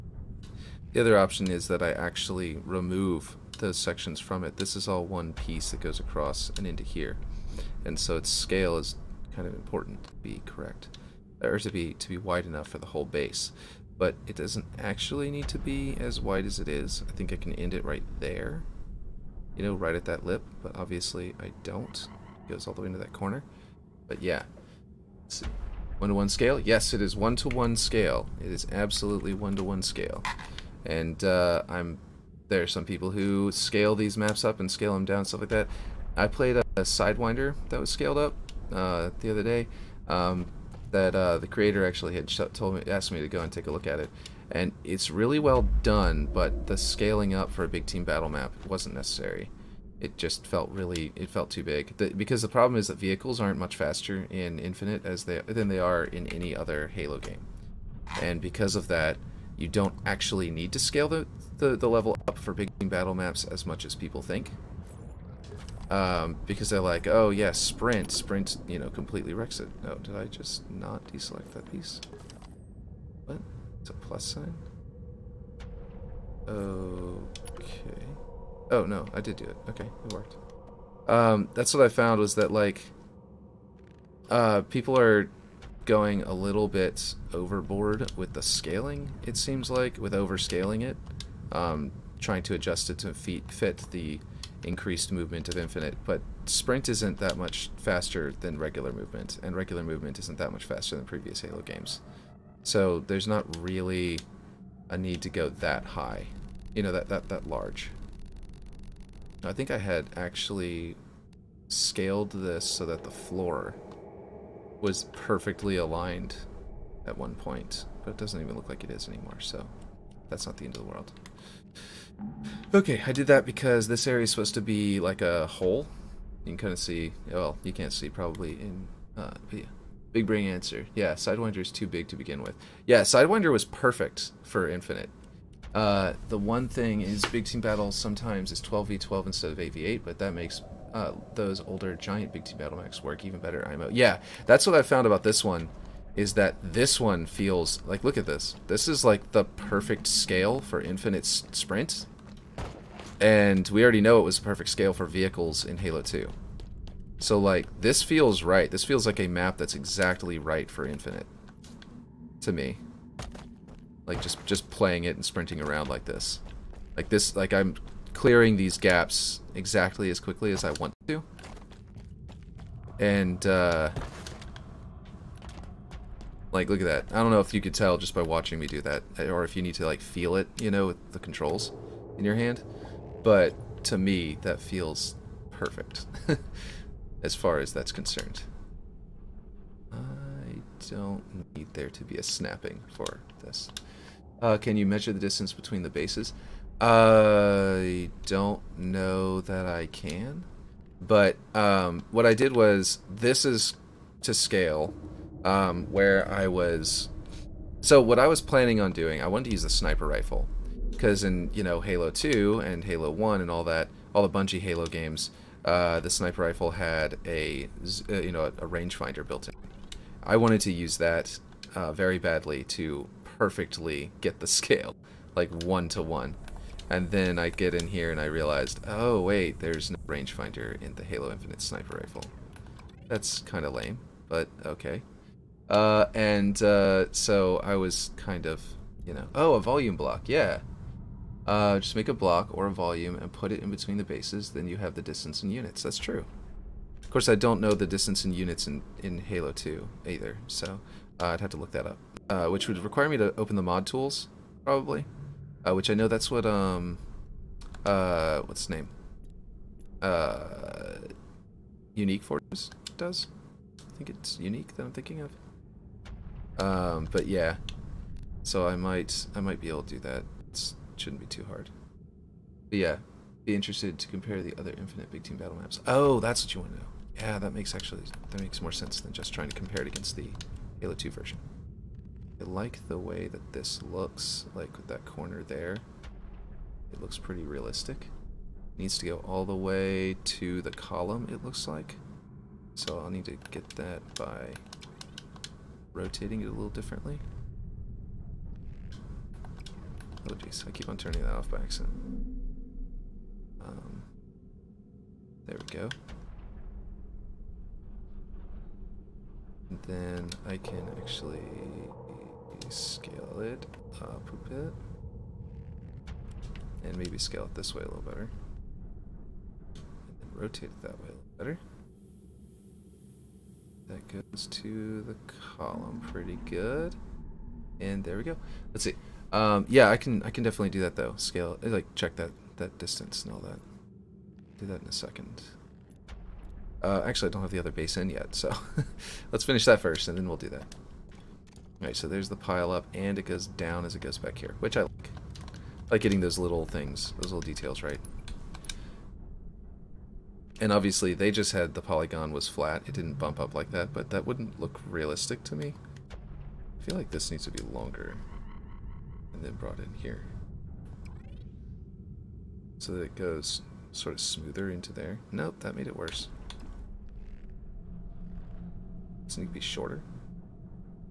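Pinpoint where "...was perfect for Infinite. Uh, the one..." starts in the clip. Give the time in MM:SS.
02:13.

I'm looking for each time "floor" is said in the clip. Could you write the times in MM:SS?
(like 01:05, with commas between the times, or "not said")
01:53.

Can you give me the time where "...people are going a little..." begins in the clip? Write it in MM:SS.
01:24.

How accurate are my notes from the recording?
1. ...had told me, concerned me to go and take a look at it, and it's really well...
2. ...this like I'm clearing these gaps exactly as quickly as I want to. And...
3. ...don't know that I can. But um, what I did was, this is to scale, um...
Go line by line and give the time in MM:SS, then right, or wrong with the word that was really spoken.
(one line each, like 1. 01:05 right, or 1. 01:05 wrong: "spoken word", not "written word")
1. 00:42 wrong: "asked", not "concerned"
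2. 02:47 right
3. 03:18 right.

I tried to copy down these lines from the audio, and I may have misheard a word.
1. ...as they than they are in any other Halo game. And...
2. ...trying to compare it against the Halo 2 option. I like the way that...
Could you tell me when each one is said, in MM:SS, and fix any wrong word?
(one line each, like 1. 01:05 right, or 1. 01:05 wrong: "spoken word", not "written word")
1. 00:55 right
2. 04:39 wrong: "version", not "option".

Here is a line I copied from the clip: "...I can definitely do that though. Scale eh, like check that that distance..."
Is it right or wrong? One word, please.
right.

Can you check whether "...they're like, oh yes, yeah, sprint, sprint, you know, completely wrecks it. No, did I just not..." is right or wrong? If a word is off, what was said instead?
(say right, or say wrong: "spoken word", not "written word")
right.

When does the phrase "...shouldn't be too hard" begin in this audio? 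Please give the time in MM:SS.
04:30.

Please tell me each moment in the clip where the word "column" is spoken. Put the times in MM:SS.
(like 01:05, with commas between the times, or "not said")
04:50, 05:25.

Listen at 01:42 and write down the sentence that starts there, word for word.
So there's not really a need to go that high.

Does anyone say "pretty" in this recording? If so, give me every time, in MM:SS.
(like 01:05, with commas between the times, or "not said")
04:47, 05:26.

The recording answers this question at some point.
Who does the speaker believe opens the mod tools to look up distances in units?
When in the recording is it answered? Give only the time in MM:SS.
04:21.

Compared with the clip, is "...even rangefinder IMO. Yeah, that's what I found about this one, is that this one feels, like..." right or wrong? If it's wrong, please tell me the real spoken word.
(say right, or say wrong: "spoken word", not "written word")
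wrong: "better", not "rangefinder".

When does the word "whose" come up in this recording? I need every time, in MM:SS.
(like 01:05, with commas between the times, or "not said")
not said.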